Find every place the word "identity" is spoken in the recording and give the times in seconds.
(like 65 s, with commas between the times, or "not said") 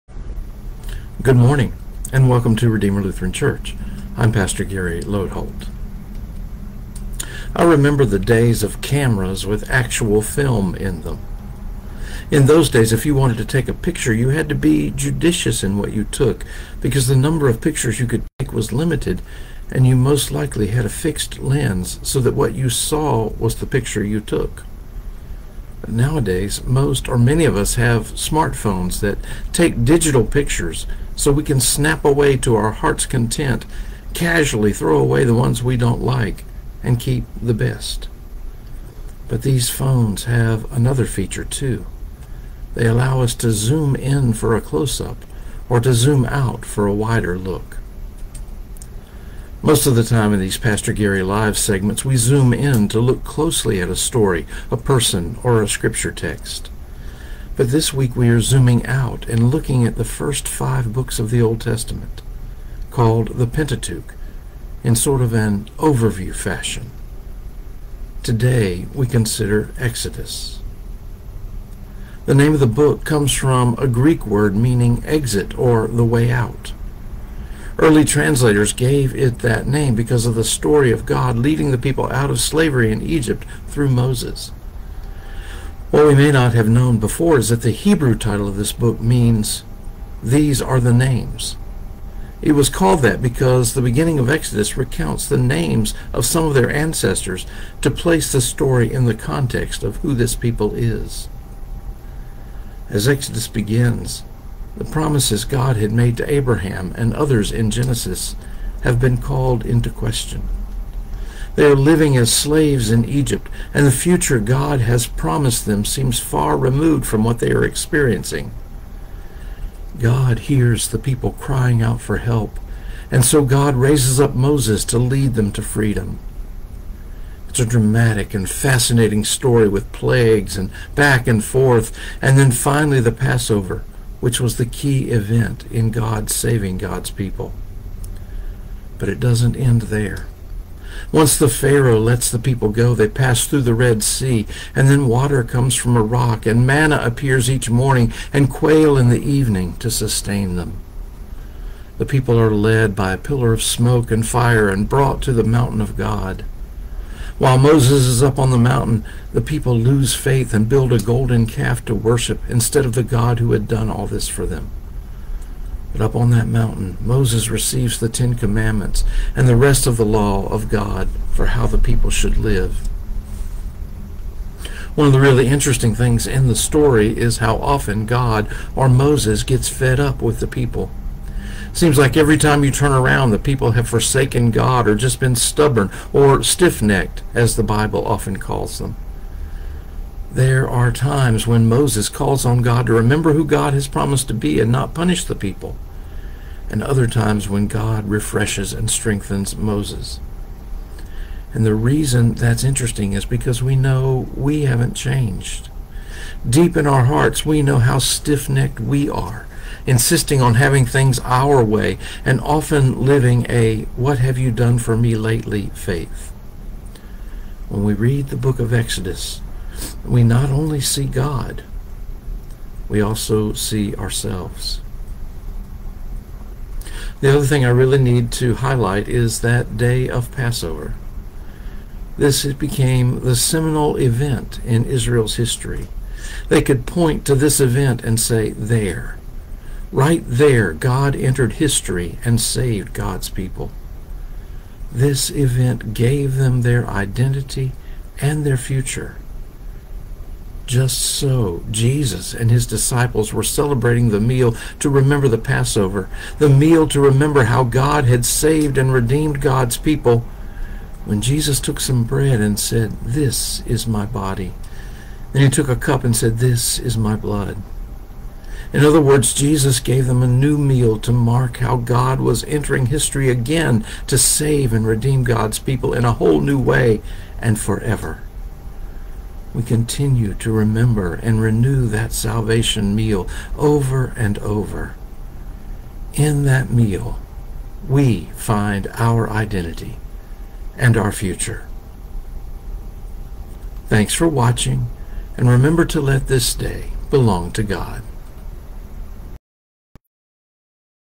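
246 s, 289 s.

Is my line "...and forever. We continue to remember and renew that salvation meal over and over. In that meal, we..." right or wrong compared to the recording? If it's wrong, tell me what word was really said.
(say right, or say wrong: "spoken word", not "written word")
right.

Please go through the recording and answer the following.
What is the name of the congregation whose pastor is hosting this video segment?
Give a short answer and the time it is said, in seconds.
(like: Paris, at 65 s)
Redeemer Lutheran Church, at 2 s.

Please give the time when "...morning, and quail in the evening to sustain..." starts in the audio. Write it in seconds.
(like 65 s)
147 s.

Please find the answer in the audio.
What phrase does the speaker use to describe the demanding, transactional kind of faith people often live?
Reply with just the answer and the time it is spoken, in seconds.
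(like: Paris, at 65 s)
what have you done for me lately, at 213 s.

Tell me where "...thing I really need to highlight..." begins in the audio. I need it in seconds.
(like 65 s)
227 s.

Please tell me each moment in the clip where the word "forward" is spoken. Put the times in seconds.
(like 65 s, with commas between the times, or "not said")
not said.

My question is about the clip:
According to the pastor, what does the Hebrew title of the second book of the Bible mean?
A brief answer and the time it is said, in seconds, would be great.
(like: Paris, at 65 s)
These Are the Names, at 90 s.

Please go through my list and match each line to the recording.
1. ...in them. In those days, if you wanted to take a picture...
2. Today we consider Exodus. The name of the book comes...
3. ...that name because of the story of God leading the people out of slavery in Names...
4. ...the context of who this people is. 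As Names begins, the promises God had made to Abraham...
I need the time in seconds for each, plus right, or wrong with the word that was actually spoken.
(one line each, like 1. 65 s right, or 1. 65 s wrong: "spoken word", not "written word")
1. 10 s right
2. 68 s right
3. 79 s wrong: "Egypt", not "Names"
4. 99 s wrong: "Exodus", not "Names".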